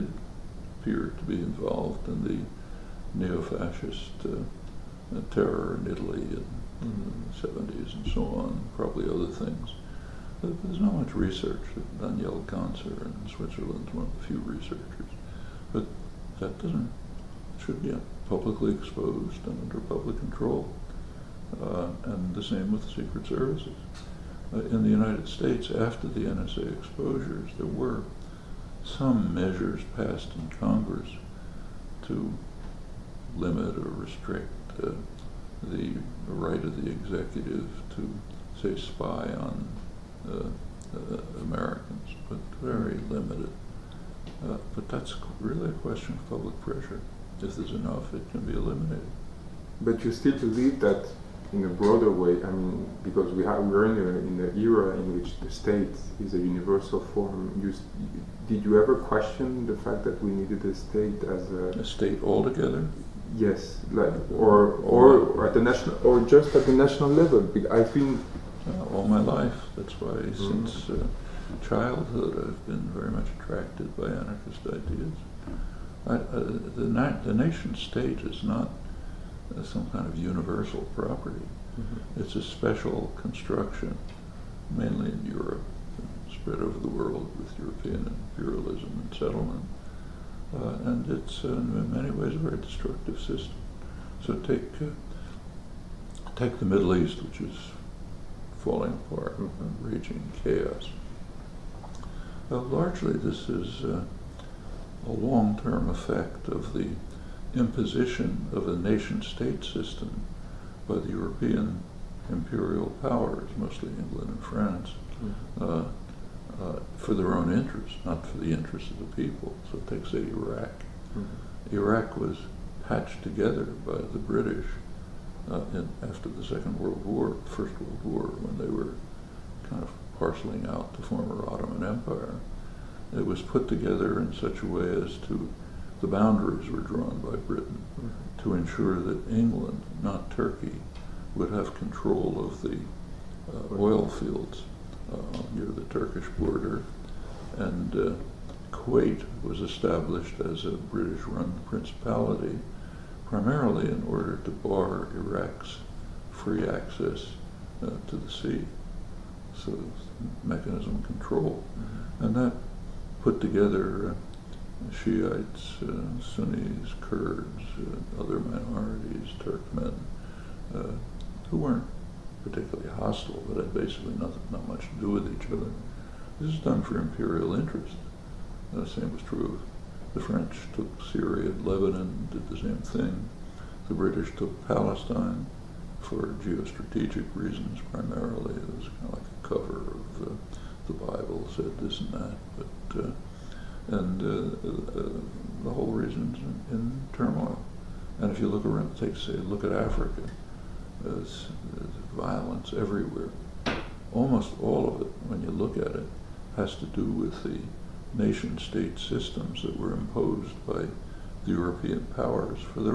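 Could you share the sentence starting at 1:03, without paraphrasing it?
Yes, like or or, or at the national or just at the national level.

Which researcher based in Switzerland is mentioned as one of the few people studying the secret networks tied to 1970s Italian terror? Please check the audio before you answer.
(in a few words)
Daniel Ganser.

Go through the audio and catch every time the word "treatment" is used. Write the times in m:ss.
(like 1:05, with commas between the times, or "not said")
not said.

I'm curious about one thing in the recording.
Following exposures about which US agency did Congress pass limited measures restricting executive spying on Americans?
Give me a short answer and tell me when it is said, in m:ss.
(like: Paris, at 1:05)
NSA, at 0:26.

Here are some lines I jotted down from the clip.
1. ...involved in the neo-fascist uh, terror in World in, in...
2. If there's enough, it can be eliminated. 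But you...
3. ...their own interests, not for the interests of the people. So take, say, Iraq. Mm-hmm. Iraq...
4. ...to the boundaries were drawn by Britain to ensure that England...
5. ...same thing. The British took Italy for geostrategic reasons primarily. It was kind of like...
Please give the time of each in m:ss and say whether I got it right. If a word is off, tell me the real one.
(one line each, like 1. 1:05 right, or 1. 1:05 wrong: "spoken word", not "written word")
1. 0:01 wrong: "Italy", not "World"
2. 0:47 right
3. 1:57 right
4. 2:15 right
5. 3:02 wrong: "Palestine", not "Italy".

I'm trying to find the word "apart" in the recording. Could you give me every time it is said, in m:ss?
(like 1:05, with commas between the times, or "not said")
1:39.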